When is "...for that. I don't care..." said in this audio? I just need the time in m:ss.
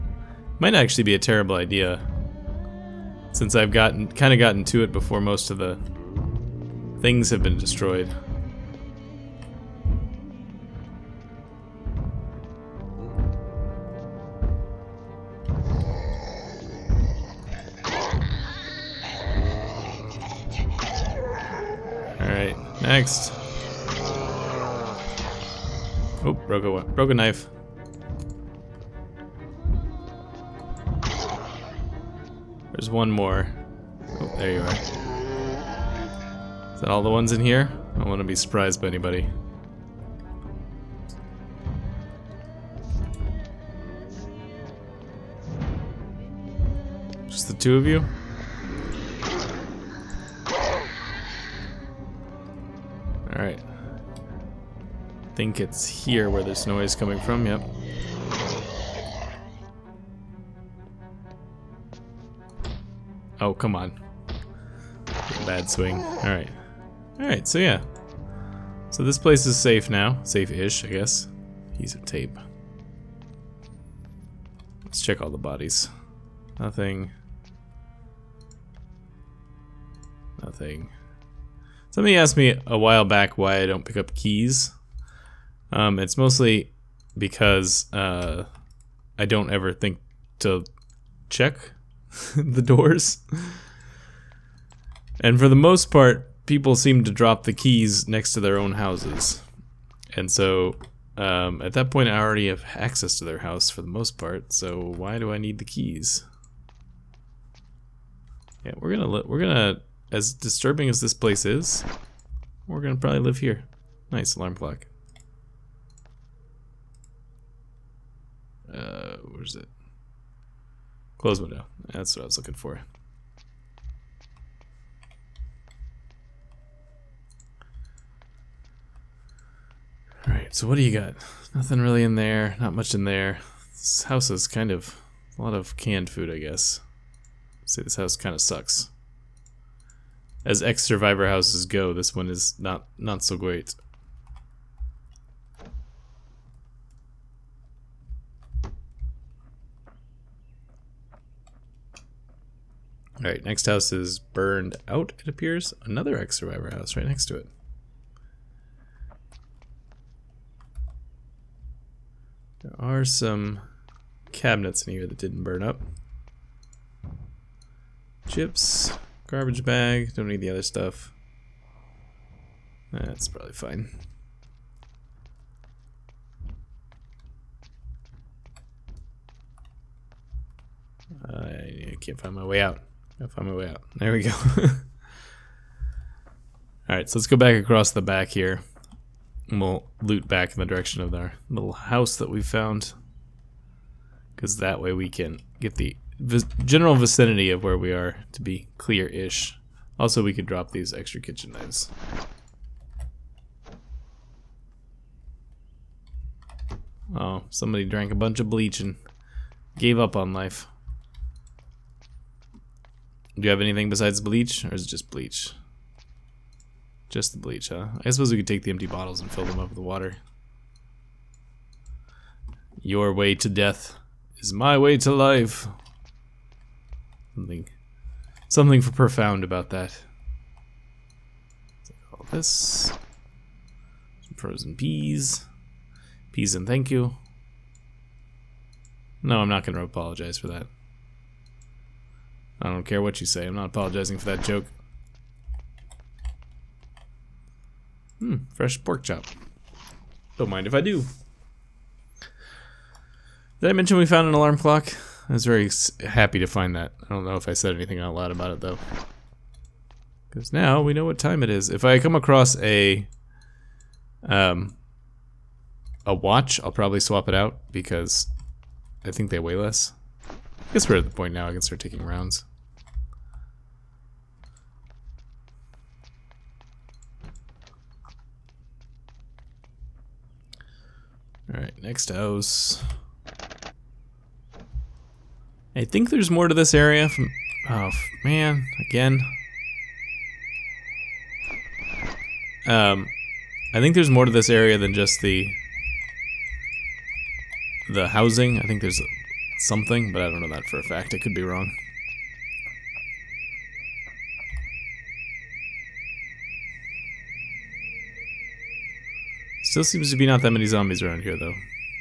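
4:00.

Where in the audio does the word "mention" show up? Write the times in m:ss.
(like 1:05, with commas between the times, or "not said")
4:13.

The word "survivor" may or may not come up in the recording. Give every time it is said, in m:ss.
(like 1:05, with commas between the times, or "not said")
2:20, 2:36.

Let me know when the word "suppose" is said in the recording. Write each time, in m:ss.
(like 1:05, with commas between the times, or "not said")
3:38.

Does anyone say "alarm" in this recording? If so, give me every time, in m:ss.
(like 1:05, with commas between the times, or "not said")
1:54, 4:14.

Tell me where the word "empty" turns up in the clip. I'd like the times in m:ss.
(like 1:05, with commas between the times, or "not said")
3:38.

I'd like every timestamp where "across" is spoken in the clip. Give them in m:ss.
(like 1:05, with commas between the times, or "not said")
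3:07, 4:22.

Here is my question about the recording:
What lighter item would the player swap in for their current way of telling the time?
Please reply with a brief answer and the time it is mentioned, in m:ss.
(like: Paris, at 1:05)
A watch, at 4:26.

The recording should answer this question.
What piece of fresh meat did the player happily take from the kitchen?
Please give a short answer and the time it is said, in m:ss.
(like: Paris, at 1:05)
Pork chop, at 4:08.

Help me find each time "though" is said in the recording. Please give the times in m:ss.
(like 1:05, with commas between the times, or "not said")
4:18, 5:11.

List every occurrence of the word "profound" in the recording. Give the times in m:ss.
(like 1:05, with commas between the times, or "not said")
3:48.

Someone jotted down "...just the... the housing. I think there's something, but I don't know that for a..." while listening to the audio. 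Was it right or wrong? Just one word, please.
right.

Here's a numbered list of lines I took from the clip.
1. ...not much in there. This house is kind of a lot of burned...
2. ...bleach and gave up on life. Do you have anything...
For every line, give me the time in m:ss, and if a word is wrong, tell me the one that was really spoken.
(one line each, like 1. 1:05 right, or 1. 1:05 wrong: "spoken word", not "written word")
1. 2:12 wrong: "canned", not "burned"
2. 3:28 right.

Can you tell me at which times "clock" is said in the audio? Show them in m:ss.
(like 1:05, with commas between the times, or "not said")
1:54, 4:14.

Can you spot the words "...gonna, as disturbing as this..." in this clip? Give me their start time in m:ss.
1:49.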